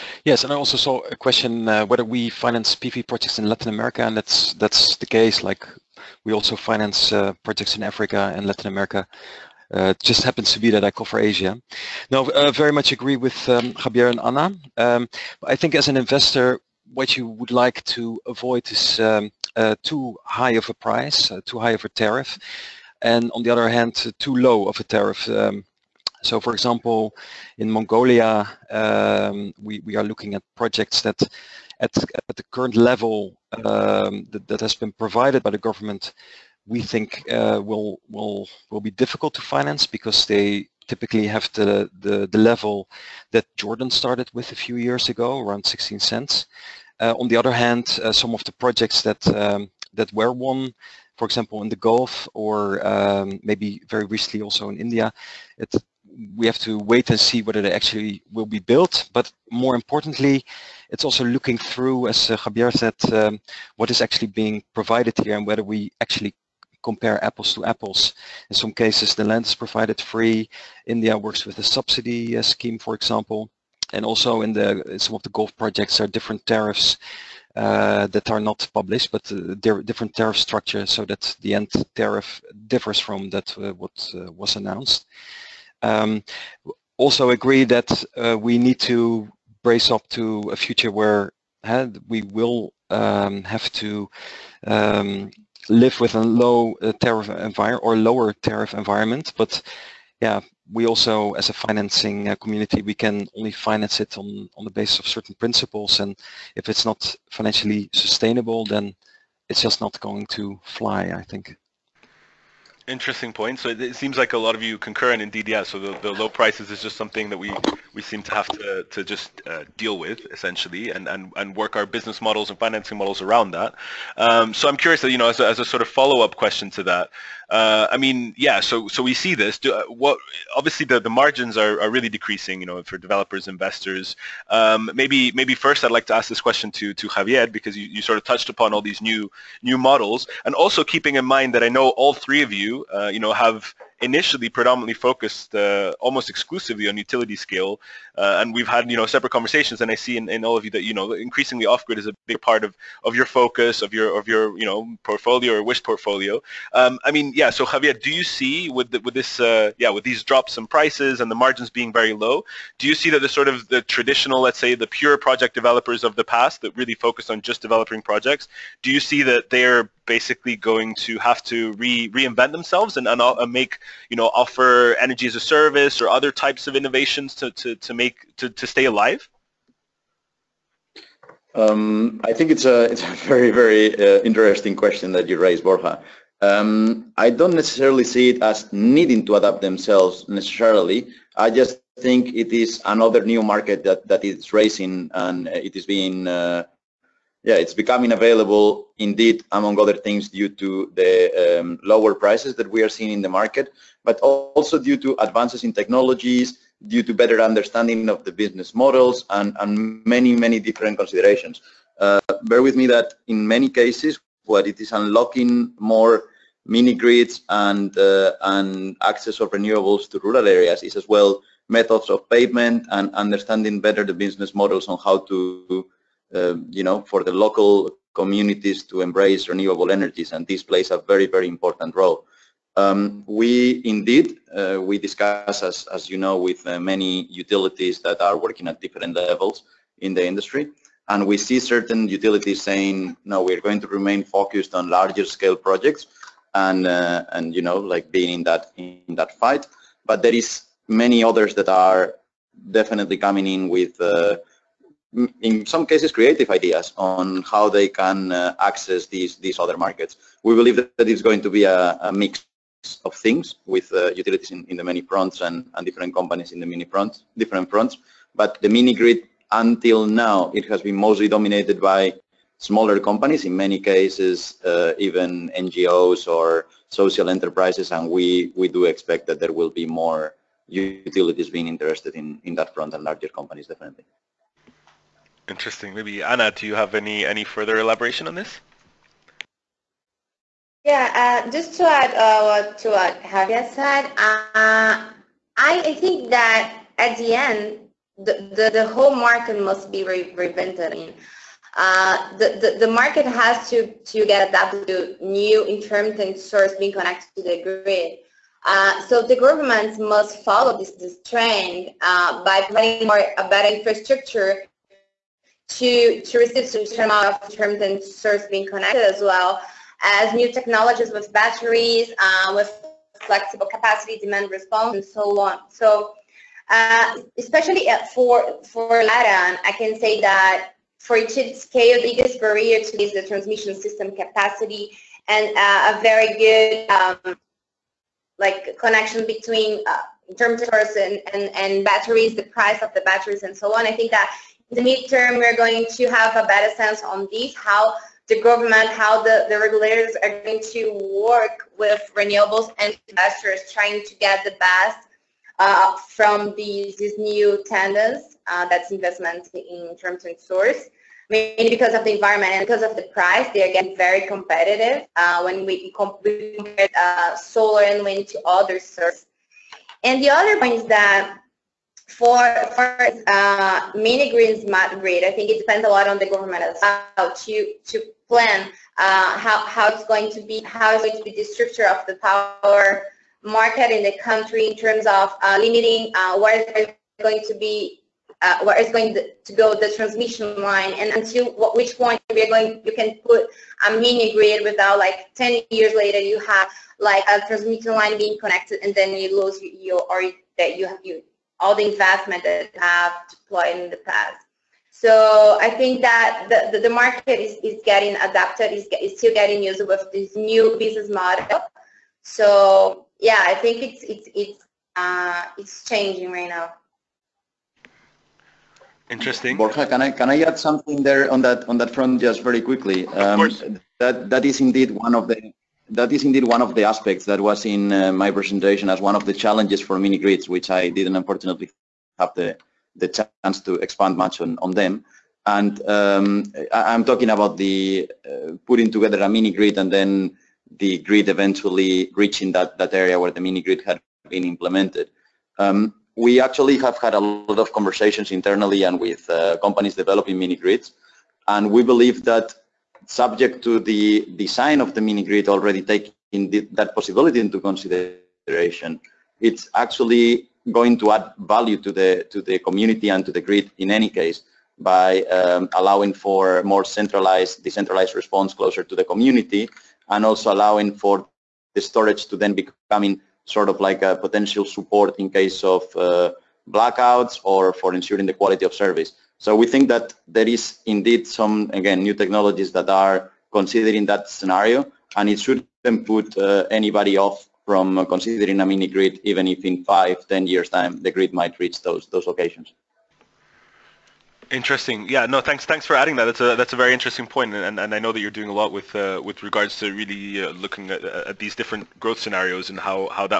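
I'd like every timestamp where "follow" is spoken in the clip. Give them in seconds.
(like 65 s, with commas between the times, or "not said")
125 s, 310 s.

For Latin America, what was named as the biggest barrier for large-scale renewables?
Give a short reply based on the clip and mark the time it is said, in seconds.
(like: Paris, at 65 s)
transmission system capacity, at 333 s.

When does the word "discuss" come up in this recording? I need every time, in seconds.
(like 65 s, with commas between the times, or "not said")
234 s.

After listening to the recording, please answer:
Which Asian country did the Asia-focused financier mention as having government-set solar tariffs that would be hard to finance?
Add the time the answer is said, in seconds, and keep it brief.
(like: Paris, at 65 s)
Mongolia, at 27 s.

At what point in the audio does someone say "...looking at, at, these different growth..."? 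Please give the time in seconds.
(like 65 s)
500 s.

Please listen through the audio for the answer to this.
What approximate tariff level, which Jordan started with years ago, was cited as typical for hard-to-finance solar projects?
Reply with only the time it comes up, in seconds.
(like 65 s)
45 s.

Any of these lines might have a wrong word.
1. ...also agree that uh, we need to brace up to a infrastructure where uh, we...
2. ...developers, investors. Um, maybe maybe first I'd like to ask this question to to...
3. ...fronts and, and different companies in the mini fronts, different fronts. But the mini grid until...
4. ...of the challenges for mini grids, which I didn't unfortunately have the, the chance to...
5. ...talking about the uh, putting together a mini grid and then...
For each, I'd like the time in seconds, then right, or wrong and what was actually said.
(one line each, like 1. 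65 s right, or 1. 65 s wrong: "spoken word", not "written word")
1. 86 s wrong: "future", not "infrastructure"
2. 132 s right
3. 265 s right
4. 429 s right
5. 437 s right.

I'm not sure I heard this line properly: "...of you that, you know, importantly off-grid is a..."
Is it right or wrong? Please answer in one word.
wrong.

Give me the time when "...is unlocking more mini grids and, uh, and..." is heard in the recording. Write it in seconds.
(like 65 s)
214 s.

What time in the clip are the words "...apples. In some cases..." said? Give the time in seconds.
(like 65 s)
67 s.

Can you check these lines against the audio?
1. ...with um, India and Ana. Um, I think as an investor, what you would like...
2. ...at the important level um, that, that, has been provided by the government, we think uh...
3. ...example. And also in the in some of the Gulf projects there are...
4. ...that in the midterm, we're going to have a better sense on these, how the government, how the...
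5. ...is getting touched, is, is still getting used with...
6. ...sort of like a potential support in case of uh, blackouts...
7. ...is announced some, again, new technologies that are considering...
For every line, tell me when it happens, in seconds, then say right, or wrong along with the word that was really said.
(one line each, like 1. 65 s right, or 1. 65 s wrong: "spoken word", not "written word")
1. 13 s wrong: "Javier", not "India"
2. 32 s wrong: "current", not "important"
3. 72 s right
4. 344 s right
5. 407 s wrong: "adapted", not "touched"
6. 473 s right
7. 480 s wrong: "indeed", not "announced".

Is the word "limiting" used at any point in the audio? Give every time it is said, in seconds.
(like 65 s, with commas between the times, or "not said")
385 s.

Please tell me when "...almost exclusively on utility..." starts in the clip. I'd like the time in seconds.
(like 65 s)
146 s.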